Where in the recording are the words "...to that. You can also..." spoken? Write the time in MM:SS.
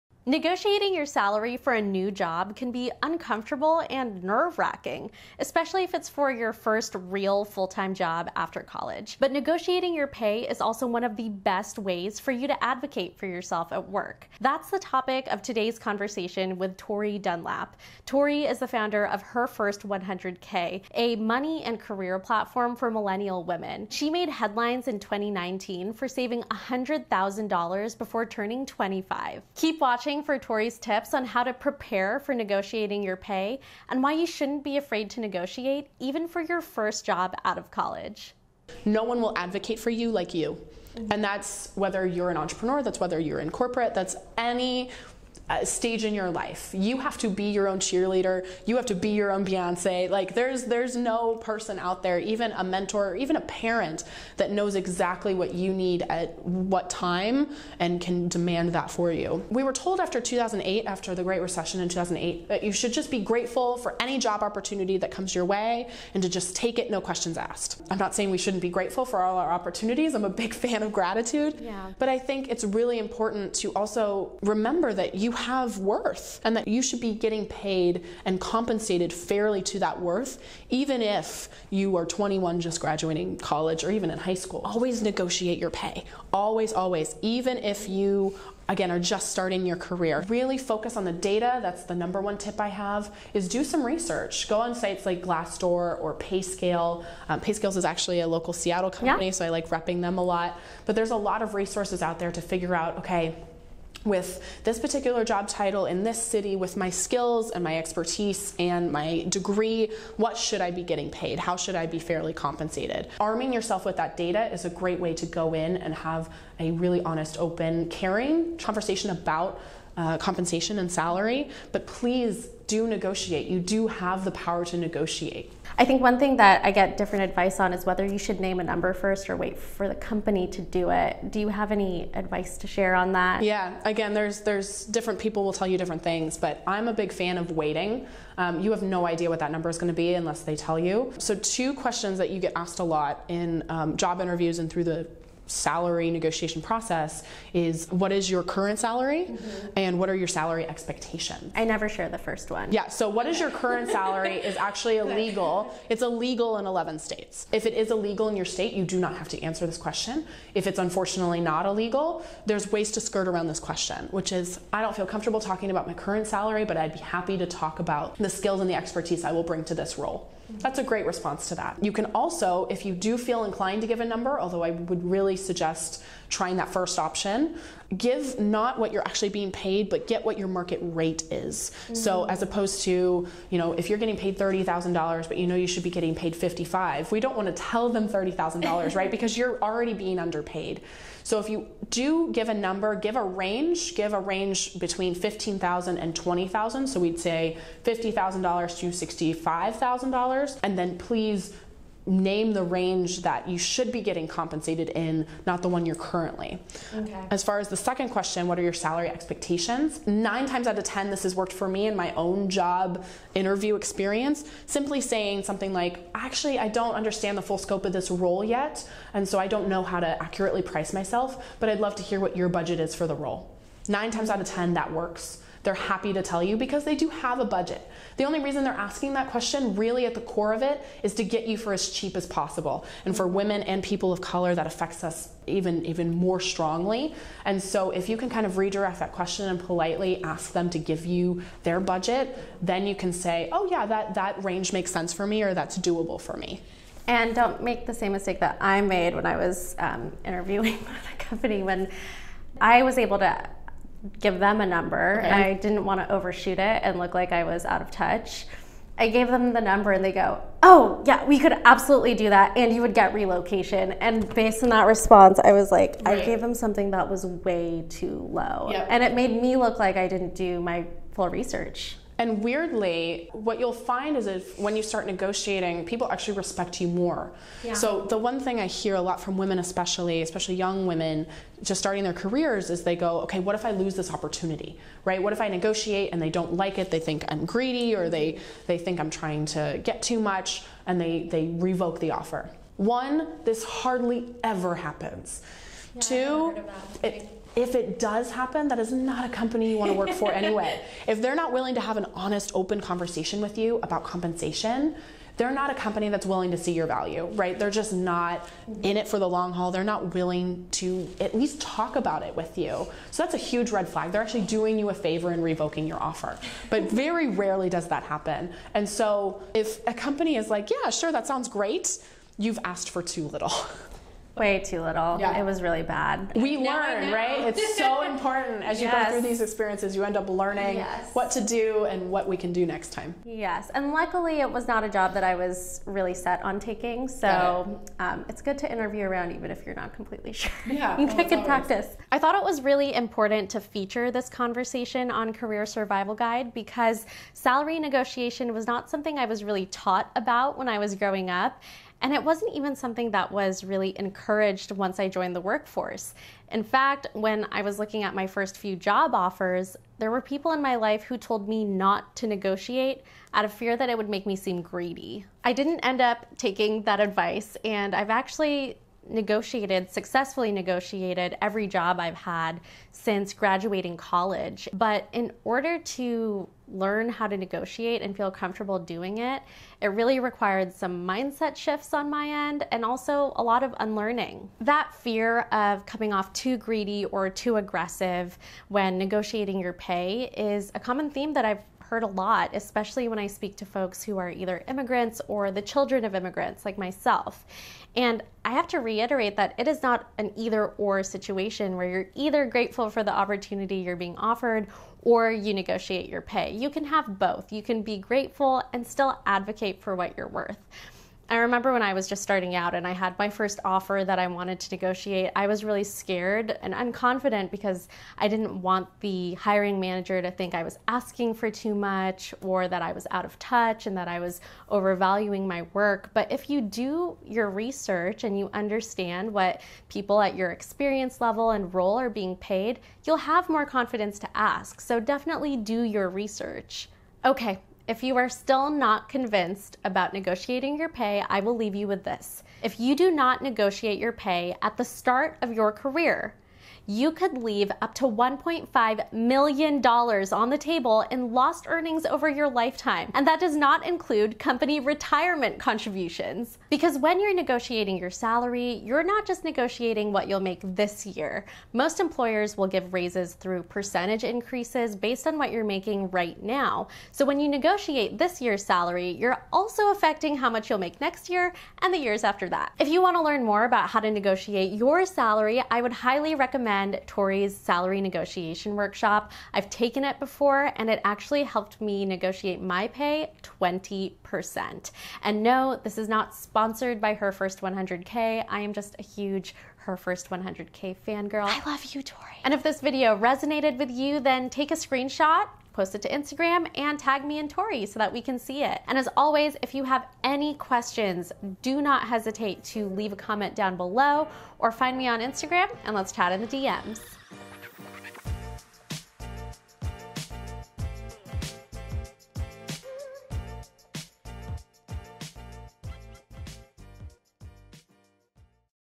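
02:51.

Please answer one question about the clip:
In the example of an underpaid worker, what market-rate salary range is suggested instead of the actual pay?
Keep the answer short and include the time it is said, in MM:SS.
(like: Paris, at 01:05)
$50,000 to $65,000, at 03:17.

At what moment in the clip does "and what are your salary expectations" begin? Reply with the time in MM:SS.
02:29.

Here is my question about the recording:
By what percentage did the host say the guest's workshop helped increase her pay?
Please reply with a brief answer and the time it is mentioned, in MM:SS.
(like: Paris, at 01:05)
20%, at 08:03.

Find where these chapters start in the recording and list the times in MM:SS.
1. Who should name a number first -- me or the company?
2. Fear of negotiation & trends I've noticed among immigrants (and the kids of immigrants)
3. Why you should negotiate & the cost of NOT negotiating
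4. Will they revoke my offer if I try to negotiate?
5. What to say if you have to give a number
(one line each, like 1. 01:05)
1. 02:05
2. 06:25
3. 07:17
4. 04:38
5. 02:56.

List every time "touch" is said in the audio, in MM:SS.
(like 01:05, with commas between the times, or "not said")
04:17, 07:03.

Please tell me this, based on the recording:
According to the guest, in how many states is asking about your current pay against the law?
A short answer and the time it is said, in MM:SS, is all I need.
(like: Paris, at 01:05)
11, at 02:36.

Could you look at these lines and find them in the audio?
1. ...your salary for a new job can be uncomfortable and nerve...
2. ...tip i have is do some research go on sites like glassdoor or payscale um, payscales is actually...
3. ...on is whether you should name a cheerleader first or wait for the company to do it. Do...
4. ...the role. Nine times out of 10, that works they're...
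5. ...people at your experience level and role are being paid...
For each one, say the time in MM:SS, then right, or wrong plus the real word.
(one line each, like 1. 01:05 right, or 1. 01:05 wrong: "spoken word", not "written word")
1. 00:00 right
2. 01:32 right
3. 02:07 wrong: "number", not "cheerleader"
4. 03:43 right
5. 07:09 right.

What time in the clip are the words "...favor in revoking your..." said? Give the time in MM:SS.
05:14.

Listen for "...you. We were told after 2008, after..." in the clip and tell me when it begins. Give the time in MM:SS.
00:59.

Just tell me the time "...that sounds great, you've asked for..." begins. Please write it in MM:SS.
05:21.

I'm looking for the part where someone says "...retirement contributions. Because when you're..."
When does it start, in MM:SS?
07:34.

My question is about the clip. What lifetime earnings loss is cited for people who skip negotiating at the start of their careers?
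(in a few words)
$1.5 million.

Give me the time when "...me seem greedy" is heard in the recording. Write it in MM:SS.
06:04.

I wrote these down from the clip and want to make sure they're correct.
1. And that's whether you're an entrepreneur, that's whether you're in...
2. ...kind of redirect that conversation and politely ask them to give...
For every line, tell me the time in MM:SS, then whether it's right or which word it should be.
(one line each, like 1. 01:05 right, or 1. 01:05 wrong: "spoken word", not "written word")
1. 00:41 right
2. 03:58 wrong: "question", not "conversation".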